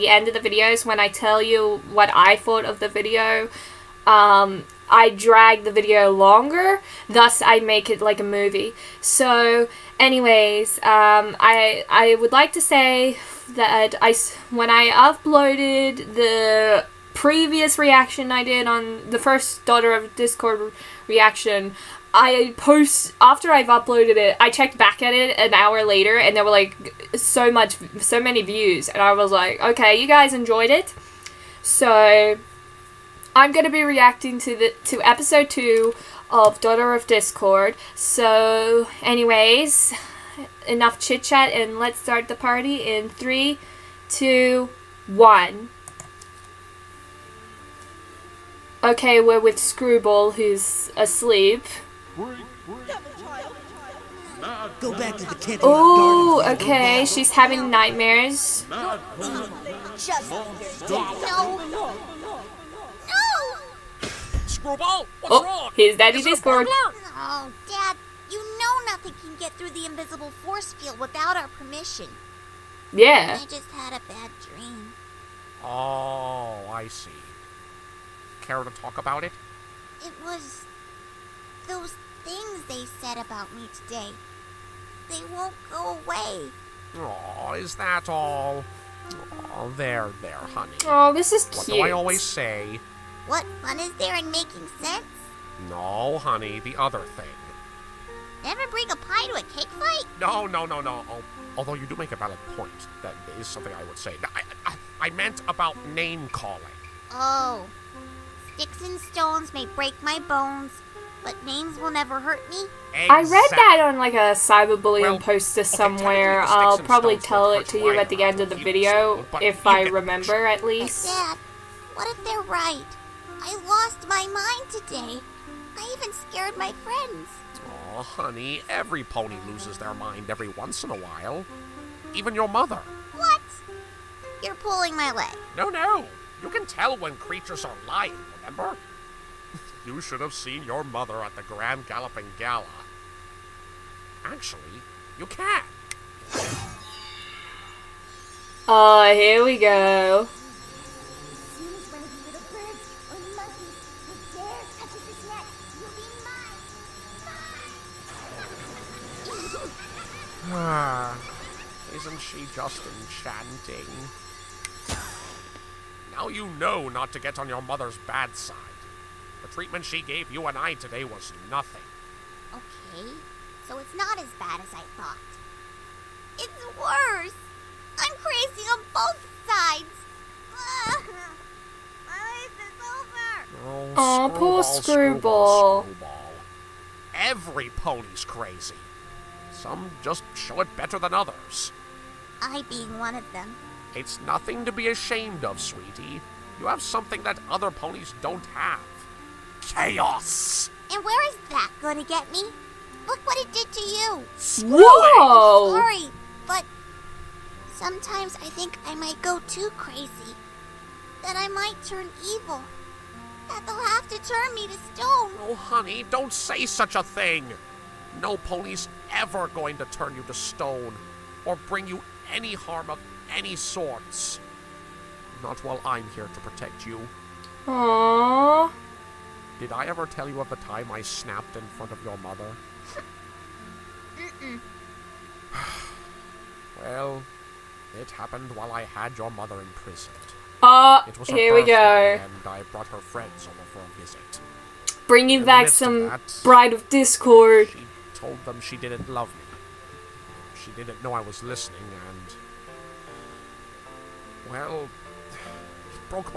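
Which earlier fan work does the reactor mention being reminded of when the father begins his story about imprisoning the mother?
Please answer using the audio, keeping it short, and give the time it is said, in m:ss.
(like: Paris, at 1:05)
Bride of Discord, at 4:06.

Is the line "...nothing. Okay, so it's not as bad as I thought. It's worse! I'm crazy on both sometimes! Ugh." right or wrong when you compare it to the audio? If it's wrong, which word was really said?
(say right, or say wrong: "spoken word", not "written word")
wrong: "sides", not "sometimes".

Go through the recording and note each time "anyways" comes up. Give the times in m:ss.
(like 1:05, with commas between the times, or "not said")
0:09, 0:39.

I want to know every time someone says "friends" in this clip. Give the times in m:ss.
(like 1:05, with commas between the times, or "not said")
2:06, 4:02.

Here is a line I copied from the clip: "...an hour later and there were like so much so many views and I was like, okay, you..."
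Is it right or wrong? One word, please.
right.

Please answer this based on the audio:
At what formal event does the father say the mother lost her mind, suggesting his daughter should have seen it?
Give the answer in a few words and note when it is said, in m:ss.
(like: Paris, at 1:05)
Grand Galloping Gala, at 2:21.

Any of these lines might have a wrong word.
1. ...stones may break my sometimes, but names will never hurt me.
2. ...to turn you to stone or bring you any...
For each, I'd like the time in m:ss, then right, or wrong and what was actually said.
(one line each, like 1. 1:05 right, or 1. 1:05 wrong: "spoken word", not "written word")
1. 1:48 wrong: "bones", not "sometimes"
2. 3:39 right.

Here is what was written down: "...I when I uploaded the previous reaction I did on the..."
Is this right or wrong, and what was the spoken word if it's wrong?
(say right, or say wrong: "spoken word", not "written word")
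right.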